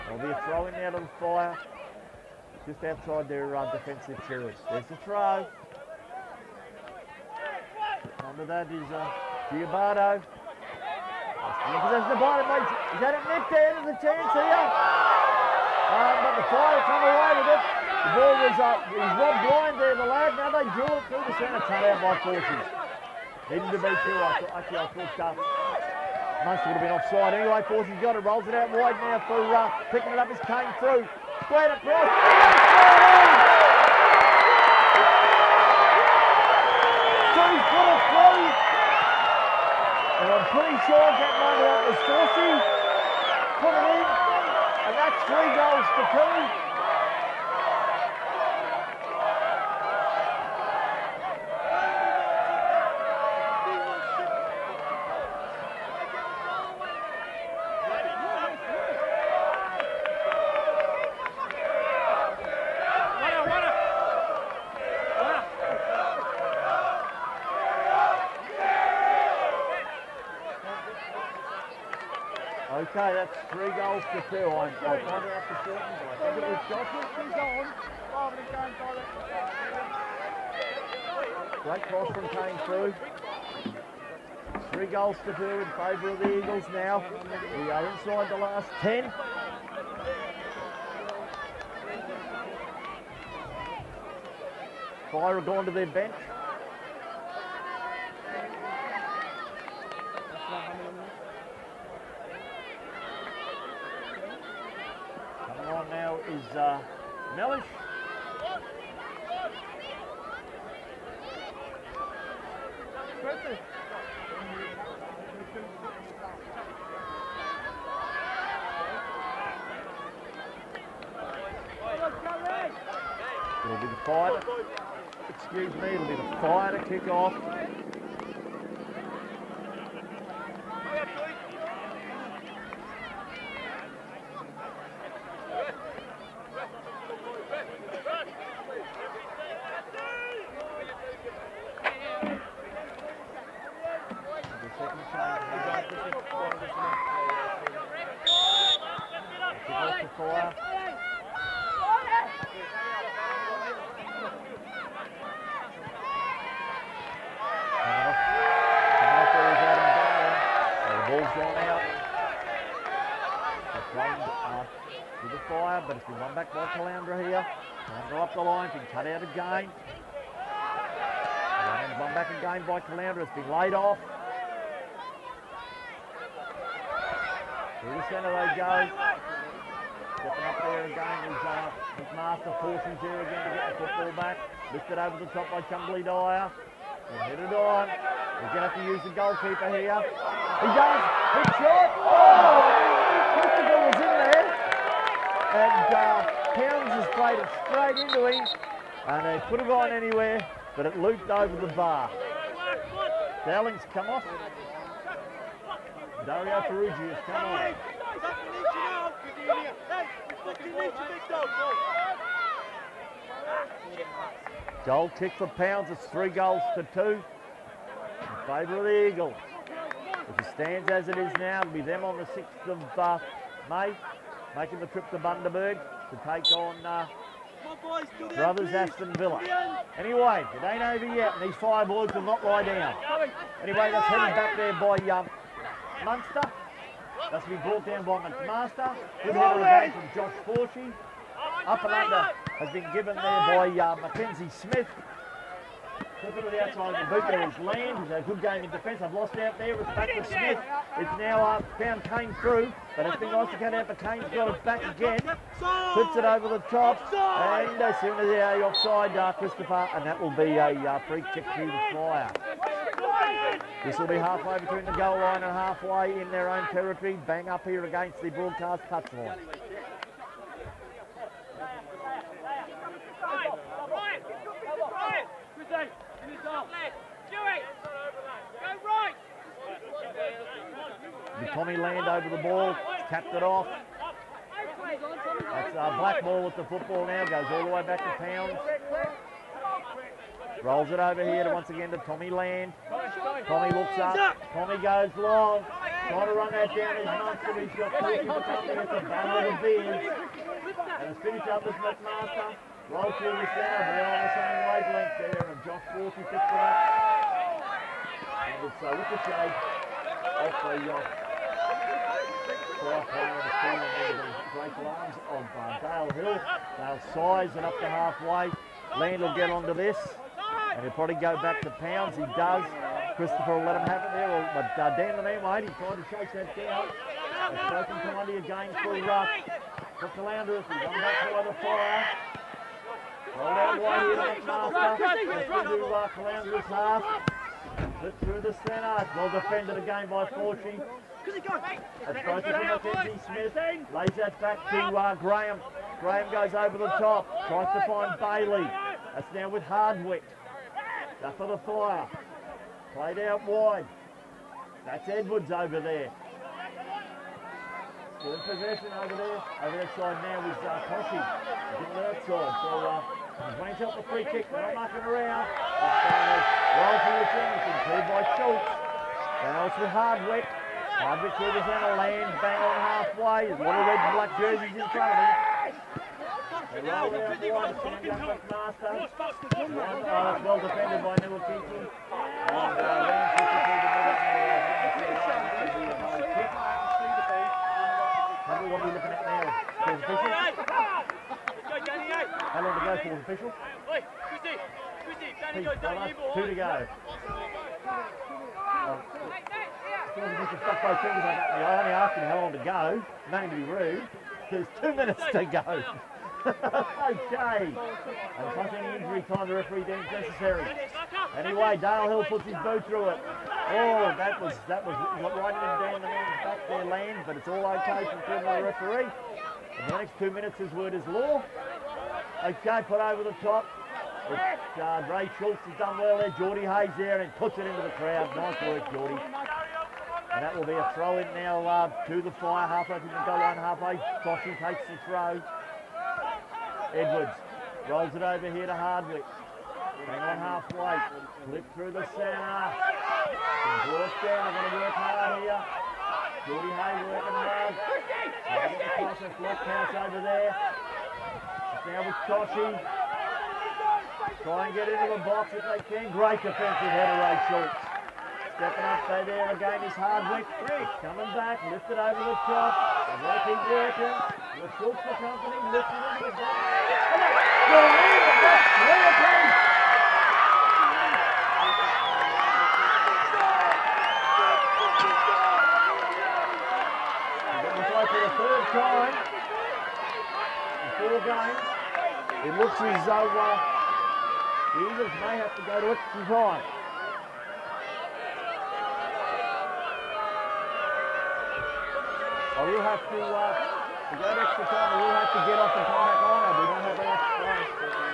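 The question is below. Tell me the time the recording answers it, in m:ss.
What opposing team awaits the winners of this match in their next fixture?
3:48.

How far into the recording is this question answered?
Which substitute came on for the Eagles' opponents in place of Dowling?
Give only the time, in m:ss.
3:26.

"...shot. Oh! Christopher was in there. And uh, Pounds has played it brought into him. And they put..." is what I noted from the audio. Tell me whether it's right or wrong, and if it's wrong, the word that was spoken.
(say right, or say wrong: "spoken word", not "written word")
wrong: "straight", not "brought".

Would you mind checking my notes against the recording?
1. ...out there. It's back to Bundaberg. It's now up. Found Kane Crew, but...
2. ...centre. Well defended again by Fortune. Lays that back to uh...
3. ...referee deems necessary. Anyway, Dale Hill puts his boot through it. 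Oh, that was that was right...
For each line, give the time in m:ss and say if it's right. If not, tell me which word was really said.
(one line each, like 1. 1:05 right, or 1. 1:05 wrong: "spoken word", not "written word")
1. 4:09 wrong: "Smith", not "Bundaberg"
2. 5:38 right
3. 6:49 right.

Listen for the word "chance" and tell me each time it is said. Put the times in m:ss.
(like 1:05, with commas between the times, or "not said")
0:13.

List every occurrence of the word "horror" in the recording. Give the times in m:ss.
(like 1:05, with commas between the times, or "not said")
not said.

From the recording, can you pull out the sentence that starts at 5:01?
And it's finished up as McMaster.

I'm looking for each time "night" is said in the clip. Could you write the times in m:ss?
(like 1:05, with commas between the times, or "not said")
not said.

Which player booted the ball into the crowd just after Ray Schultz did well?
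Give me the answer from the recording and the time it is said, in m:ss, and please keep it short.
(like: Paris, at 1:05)
Geordie Hayes, at 7:06.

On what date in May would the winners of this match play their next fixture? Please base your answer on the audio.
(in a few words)
6th of May.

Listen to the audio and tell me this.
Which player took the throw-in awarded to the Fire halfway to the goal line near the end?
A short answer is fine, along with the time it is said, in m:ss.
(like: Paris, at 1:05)
Bossy, at 7:14.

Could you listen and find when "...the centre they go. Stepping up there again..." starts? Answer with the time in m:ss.
2:57.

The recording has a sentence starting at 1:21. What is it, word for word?
Uh, great cross from Kane Crew.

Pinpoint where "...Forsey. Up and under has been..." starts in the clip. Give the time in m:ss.
4:00.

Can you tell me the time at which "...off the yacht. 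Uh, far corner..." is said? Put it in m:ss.
5:10.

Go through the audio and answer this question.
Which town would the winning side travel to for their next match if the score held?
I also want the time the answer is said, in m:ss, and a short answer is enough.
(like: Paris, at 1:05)
Bundaberg, at 3:45.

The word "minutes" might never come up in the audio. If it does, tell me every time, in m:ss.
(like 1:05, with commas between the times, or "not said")
6:44, 7:00.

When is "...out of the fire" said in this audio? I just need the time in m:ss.
0:00.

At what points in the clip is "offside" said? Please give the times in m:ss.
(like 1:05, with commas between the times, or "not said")
0:26, 4:18.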